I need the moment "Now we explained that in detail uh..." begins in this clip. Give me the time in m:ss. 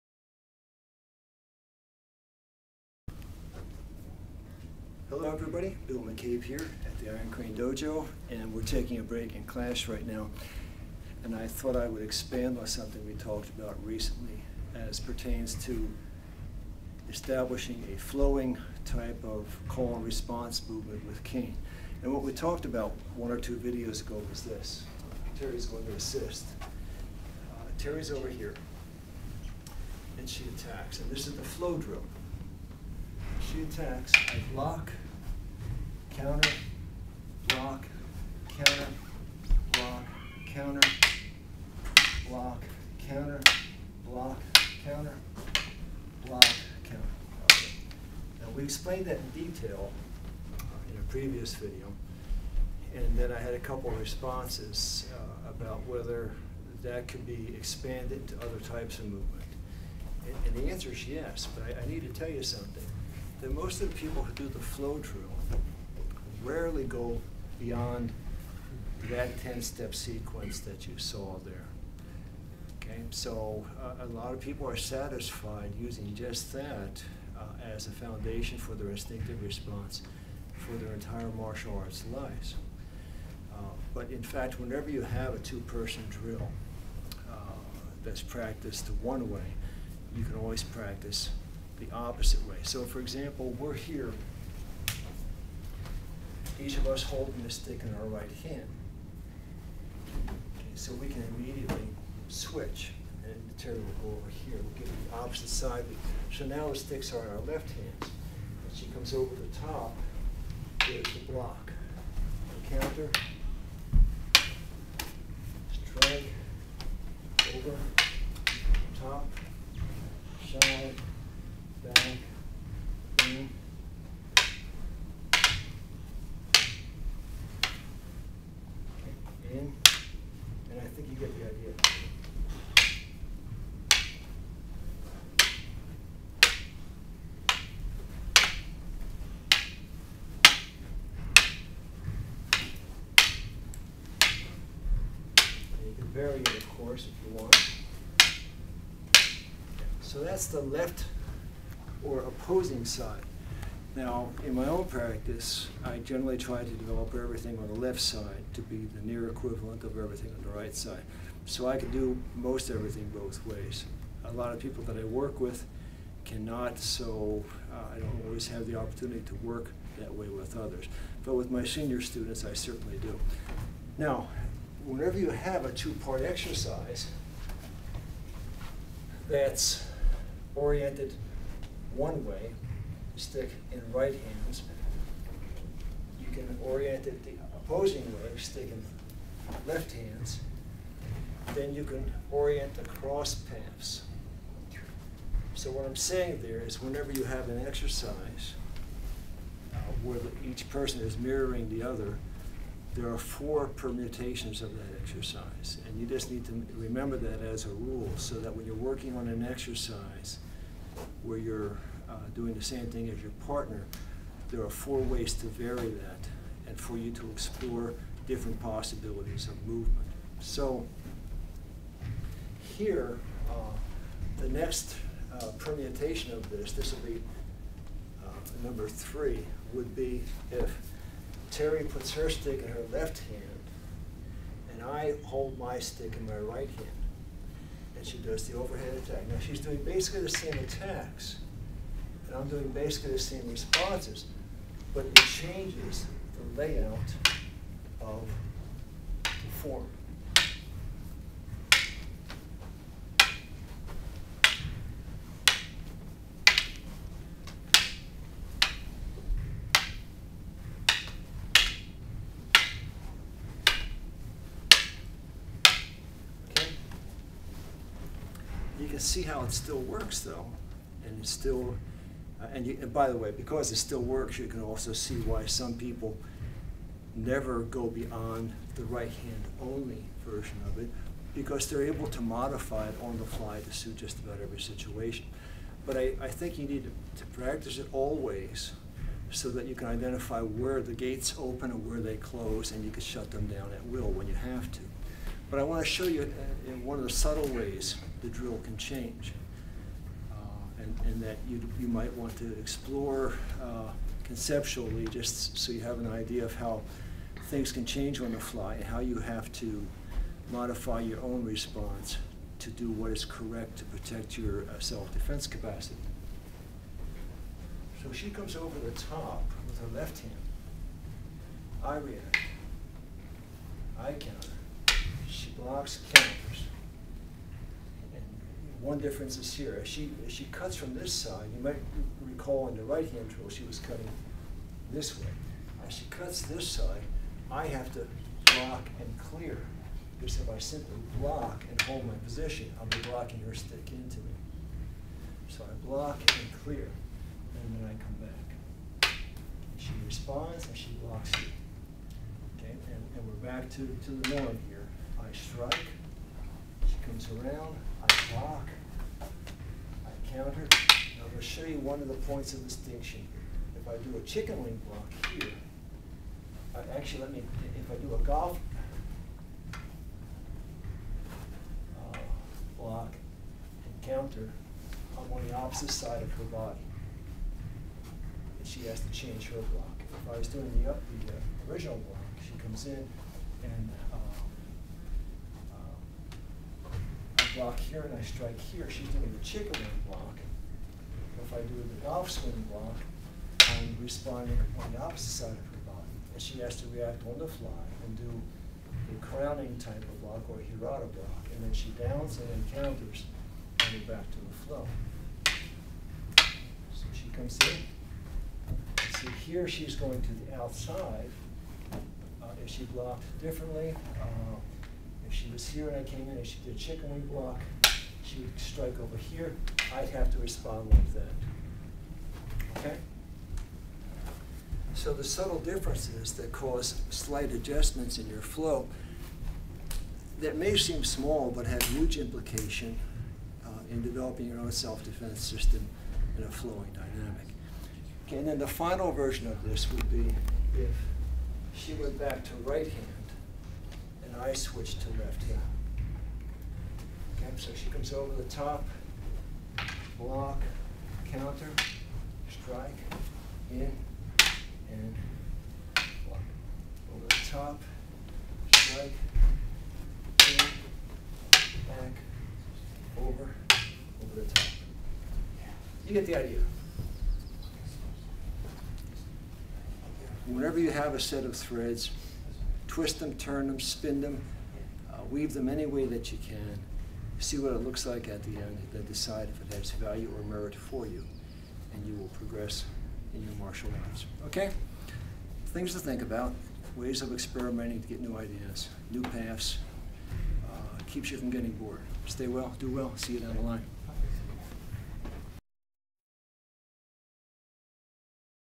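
0:48.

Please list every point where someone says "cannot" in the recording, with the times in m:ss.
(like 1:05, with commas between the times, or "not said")
2:46.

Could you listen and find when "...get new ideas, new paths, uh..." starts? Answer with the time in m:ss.
8:08.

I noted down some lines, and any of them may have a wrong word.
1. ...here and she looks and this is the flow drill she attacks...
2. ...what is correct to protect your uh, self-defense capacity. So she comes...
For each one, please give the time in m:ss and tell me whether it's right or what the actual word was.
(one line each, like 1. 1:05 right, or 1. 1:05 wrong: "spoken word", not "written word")
1. 0:28 wrong: "attacks", not "looks"
2. 5:12 right.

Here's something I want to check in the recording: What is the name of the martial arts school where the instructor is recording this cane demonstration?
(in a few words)
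Iron Crane Dojo.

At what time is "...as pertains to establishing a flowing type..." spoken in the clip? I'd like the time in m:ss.
0:14.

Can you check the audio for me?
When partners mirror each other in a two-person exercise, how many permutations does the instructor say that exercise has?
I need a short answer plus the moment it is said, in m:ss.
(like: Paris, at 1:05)
4, at 3:23.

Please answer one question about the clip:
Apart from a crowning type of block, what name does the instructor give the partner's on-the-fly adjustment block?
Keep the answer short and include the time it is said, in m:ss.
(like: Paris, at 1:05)
hirata block, at 6:40.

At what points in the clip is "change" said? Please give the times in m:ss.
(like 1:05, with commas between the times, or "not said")
4:05, 4:58, 5:07, 6:19.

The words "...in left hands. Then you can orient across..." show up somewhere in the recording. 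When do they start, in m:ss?
3:08.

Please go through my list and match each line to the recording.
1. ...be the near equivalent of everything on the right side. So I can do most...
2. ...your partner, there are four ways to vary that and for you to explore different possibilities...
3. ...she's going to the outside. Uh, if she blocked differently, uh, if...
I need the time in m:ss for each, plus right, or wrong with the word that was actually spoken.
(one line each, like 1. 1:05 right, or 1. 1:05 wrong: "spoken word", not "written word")
1. 2:38 right
2. 3:33 right
3. 6:49 right.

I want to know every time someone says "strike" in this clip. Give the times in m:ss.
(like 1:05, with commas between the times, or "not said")
1:55, 5:55, 6:28, 6:58, 7:32, 7:38.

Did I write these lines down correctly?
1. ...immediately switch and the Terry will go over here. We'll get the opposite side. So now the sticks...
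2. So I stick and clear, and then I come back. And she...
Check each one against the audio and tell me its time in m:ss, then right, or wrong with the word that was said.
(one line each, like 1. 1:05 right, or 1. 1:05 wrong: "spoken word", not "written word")
1. 1:41 right
2. 5:45 wrong: "block", not "stick".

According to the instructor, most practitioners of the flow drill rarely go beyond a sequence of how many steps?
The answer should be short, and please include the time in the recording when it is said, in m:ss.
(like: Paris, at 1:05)
10, at 1:09.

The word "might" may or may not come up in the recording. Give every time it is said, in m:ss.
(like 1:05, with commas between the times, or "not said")
5:01, 5:31.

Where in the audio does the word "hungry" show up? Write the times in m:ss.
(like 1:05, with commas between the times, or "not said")
not said.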